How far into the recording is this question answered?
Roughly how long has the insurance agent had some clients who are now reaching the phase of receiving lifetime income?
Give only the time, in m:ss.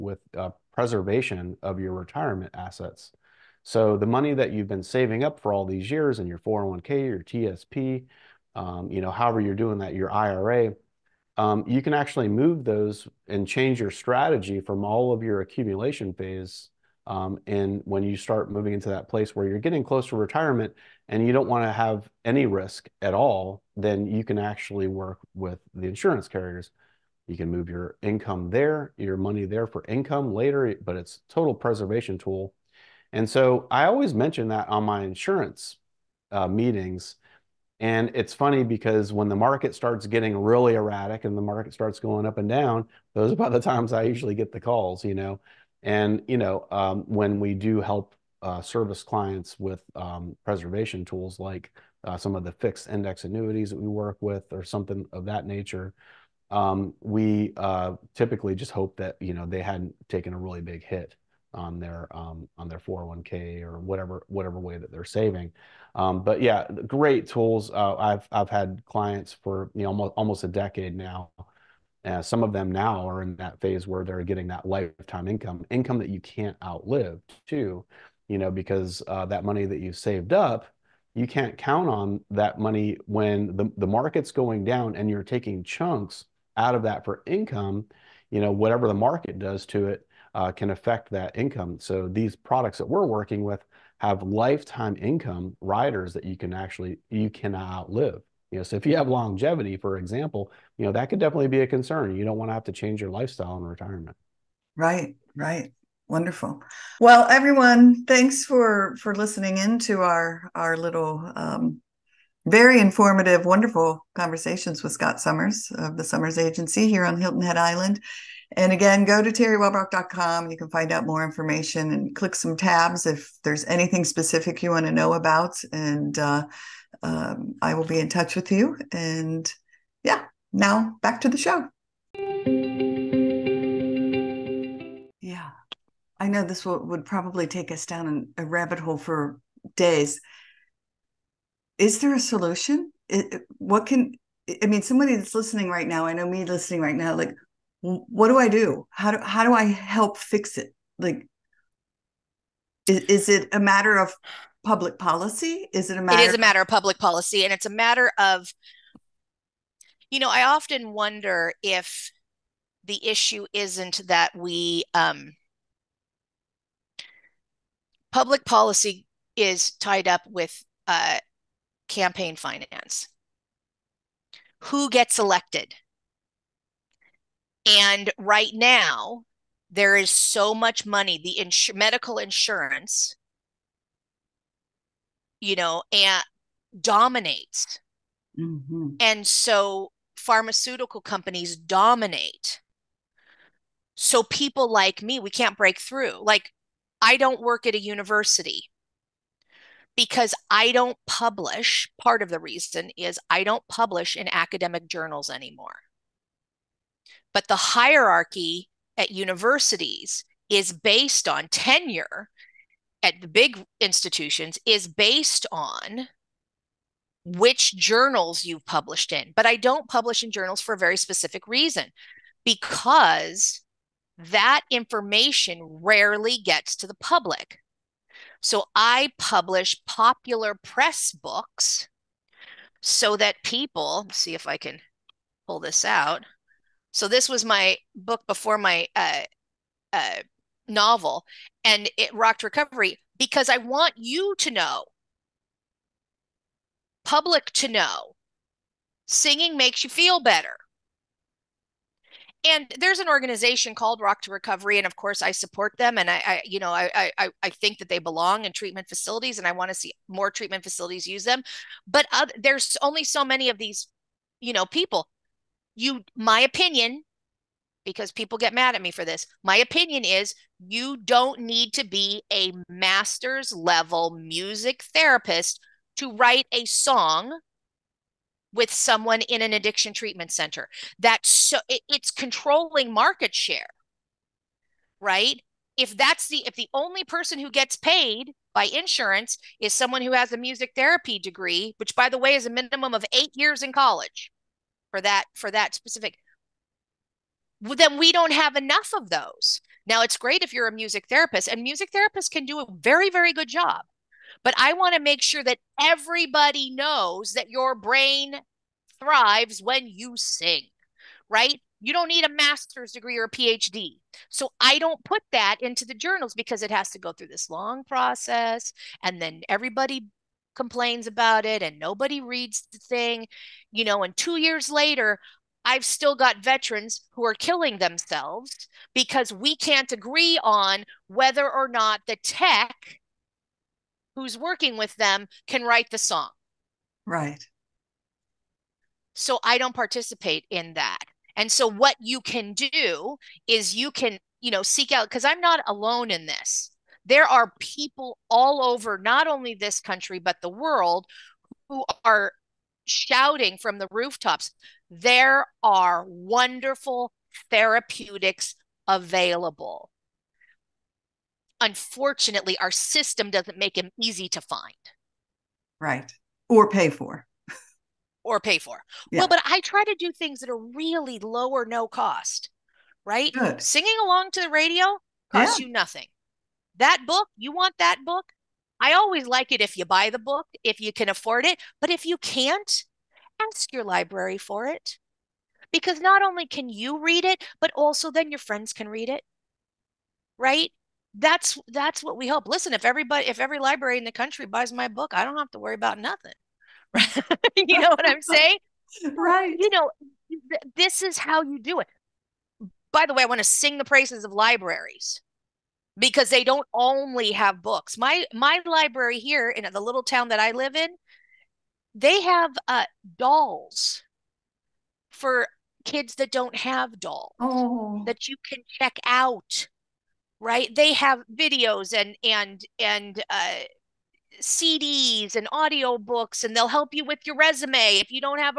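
1:09.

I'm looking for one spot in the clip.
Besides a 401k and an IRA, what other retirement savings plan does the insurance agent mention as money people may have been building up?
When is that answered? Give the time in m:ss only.
0:07.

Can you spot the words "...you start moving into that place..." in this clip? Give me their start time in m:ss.
0:18.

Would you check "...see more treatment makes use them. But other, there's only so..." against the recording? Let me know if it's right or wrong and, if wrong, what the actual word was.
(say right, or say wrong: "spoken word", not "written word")
wrong: "facilities", not "makes".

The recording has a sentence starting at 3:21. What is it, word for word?
Part of the reason is I don't publish in academic journals anymore.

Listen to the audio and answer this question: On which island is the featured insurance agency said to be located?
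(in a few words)
Hilton Head Island.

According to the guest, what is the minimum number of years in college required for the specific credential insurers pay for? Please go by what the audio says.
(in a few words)
8 years.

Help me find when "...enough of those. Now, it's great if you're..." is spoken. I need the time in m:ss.
4:58.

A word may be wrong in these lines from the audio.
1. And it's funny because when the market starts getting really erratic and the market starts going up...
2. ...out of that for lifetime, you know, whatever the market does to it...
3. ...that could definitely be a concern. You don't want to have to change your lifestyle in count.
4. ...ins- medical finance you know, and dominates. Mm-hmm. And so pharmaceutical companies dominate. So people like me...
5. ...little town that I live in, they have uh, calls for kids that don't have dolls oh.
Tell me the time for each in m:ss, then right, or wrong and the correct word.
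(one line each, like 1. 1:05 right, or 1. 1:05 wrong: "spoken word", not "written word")
1. 0:37 right
2. 1:26 wrong: "income", not "lifetime"
3. 1:40 wrong: "retirement", not "count"
4. 3:01 wrong: "insurance", not "finance"
5. 6:49 wrong: "dolls", not "calls".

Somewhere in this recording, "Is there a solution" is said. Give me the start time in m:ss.
2:21.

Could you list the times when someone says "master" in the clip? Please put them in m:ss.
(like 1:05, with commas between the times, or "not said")
4:32, 5:12.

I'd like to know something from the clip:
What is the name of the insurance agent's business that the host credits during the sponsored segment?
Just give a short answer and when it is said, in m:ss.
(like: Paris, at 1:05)
Summers Agency, at 1:56.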